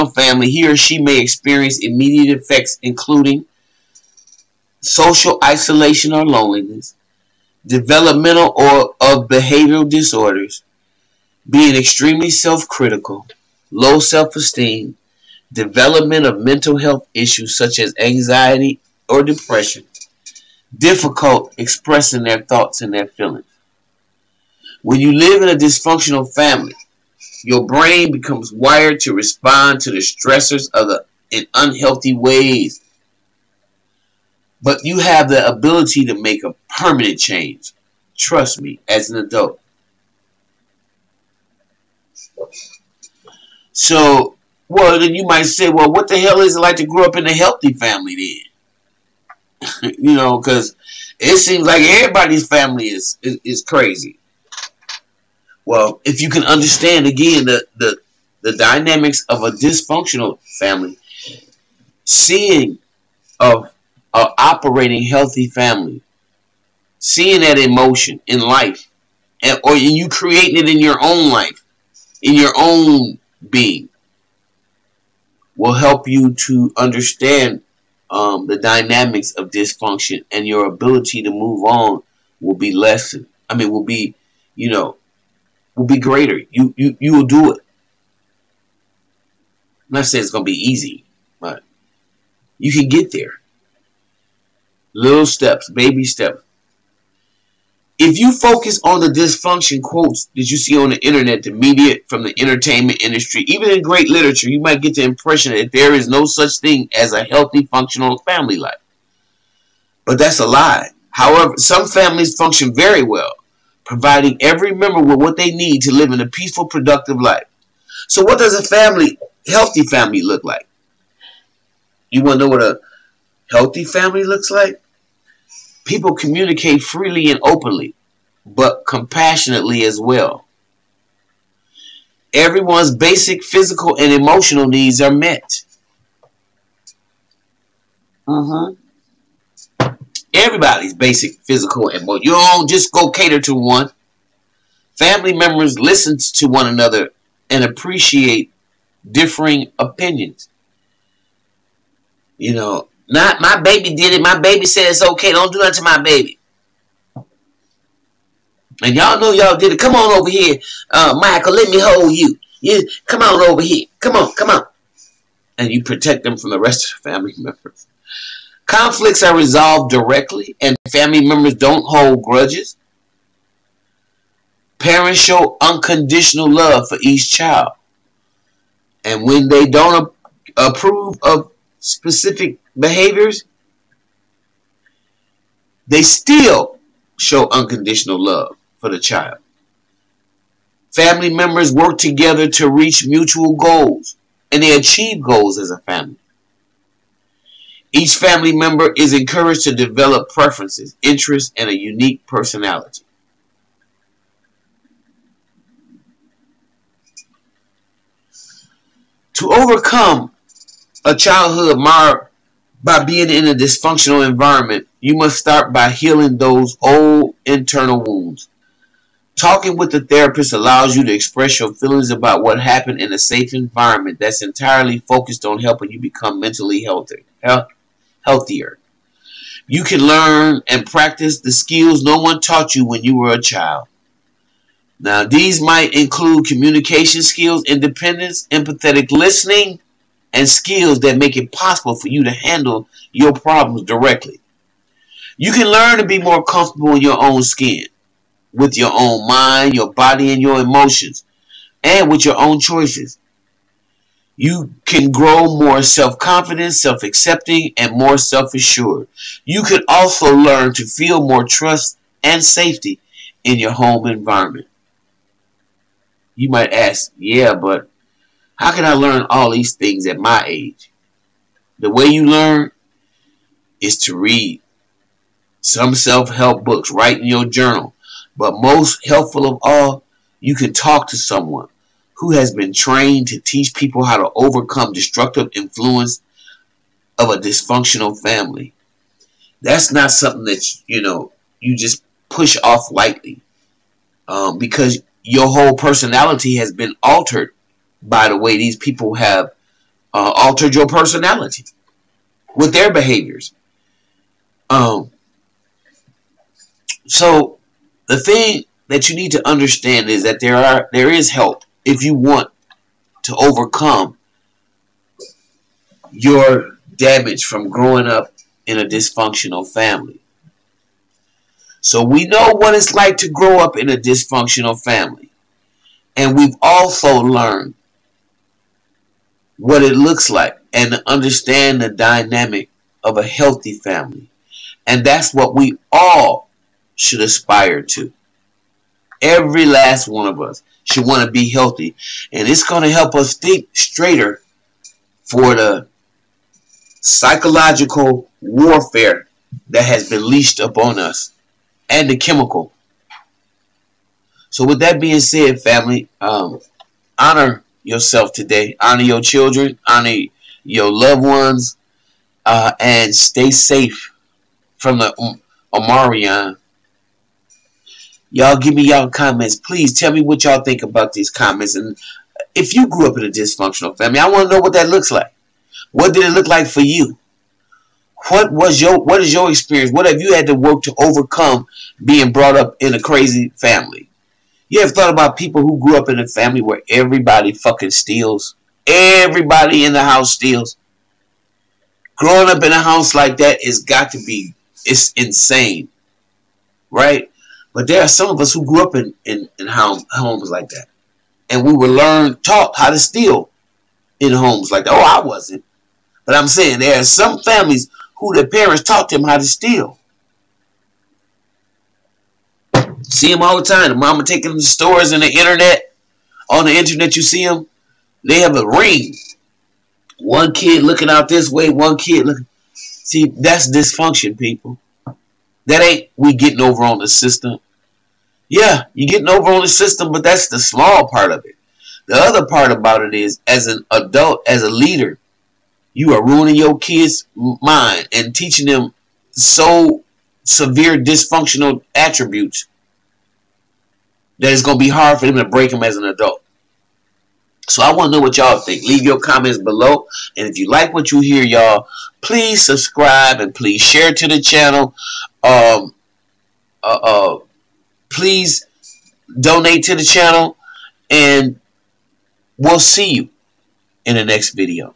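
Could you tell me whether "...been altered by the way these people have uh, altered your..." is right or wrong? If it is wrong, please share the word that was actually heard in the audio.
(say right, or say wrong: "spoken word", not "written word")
right.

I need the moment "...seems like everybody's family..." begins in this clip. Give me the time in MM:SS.
00:51.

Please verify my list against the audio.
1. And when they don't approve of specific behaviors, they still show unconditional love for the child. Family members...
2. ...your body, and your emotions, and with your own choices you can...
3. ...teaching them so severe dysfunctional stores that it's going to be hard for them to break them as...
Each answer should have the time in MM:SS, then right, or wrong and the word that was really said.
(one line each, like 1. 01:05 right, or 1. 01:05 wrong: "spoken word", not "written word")
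1. 02:59 right
2. 04:09 right
3. 07:18 wrong: "attributes", not "stores".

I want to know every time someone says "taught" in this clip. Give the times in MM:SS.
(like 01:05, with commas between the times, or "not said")
03:52, 06:42, 06:48.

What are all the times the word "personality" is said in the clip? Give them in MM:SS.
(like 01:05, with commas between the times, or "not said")
03:22, 04:55, 05:00.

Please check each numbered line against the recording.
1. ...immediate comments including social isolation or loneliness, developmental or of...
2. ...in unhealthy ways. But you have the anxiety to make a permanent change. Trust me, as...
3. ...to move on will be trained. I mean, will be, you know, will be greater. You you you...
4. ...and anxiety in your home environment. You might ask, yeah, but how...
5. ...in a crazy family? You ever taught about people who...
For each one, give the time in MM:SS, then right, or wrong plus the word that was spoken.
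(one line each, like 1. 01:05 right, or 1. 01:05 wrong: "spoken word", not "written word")
1. 00:01 wrong: "effects", not "comments"
2. 00:31 wrong: "ability", not "anxiety"
3. 01:21 wrong: "lessened", not "trained"
4. 04:22 wrong: "safety", not "anxiety"
5. 06:22 wrong: "thought", not "taught".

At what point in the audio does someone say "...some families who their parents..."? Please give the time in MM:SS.
06:47.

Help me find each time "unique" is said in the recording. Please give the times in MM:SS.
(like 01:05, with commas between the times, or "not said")
03:21.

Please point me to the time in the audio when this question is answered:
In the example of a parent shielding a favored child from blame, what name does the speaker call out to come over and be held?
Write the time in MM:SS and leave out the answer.
02:41.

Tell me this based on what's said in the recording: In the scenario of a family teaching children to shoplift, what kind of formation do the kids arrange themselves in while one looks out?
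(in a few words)
a ring.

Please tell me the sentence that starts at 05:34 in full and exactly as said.
And that's what we all should aspire to.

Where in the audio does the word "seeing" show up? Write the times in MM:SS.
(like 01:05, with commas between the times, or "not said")
01:02, 01:06.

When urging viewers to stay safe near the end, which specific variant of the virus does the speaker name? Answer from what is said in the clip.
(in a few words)
Omicron.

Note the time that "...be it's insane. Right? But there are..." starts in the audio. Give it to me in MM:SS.
06:34.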